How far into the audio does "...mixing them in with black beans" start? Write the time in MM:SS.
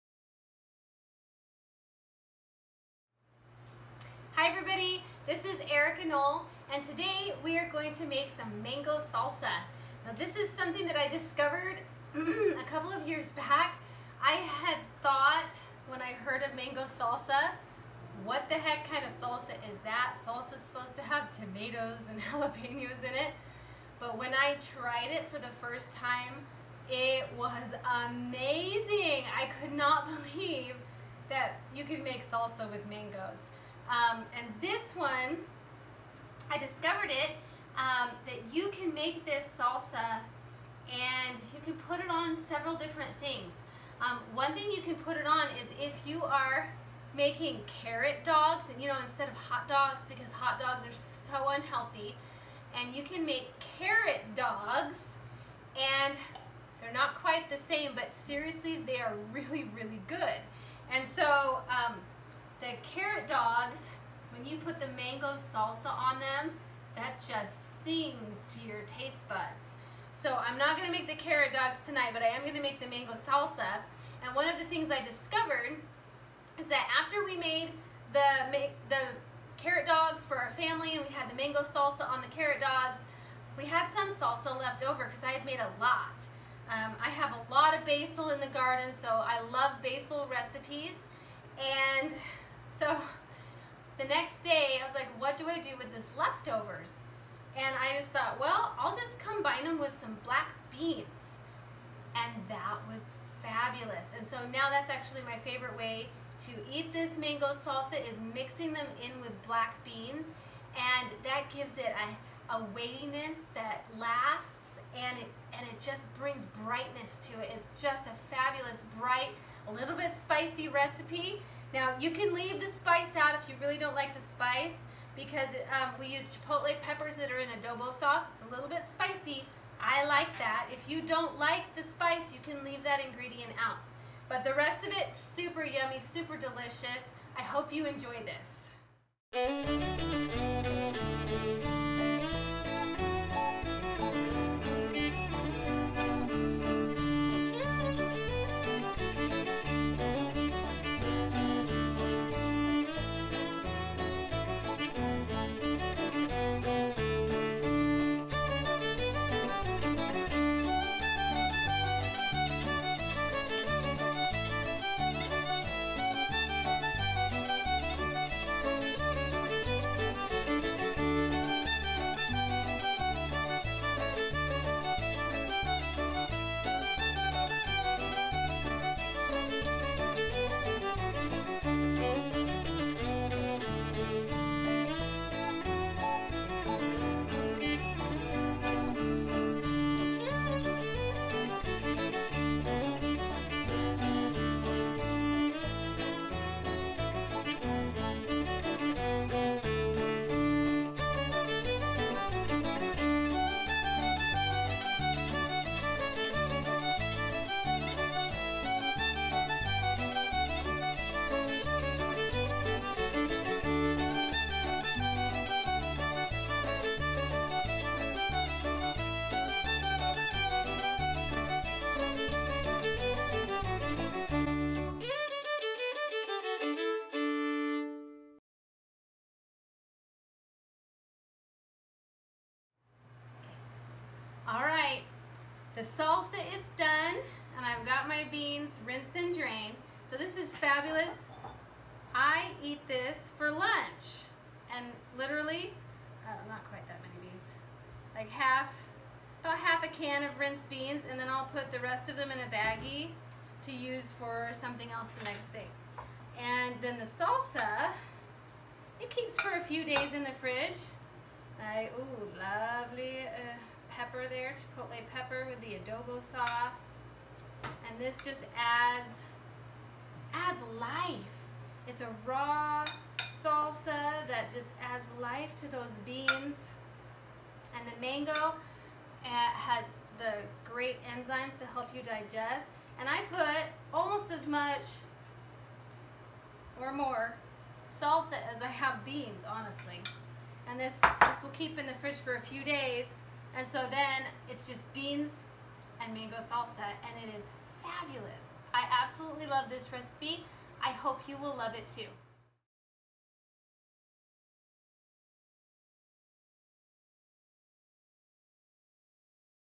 01:48.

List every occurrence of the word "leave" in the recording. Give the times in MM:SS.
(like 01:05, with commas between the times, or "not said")
02:02, 02:12.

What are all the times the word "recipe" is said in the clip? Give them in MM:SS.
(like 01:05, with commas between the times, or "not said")
01:30, 02:00, 04:59.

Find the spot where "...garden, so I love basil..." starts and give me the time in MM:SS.
01:28.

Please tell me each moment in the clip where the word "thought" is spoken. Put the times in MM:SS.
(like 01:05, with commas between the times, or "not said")
00:15, 01:38.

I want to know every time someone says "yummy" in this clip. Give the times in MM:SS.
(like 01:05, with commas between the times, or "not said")
02:15.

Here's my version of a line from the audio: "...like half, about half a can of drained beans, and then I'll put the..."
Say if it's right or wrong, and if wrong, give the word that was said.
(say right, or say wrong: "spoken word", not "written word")
wrong: "rinsed", not "drained".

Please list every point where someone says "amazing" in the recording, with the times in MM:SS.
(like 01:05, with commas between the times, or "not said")
00:28.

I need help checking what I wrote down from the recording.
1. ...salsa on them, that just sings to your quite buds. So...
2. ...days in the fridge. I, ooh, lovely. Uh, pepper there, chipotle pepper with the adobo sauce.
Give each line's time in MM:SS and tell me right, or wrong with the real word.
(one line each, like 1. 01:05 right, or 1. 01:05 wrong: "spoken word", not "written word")
1. 01:05 wrong: "taste", not "quite"
2. 04:19 right.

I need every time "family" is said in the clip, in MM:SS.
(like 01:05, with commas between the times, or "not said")
01:20.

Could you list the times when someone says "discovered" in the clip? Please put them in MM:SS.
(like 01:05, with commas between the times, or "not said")
00:11, 00:36, 01:15.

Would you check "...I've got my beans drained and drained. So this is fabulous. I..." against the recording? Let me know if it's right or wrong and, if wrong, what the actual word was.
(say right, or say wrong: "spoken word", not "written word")
wrong: "rinsed", not "drained".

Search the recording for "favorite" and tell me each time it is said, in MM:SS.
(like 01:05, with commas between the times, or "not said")
01:45.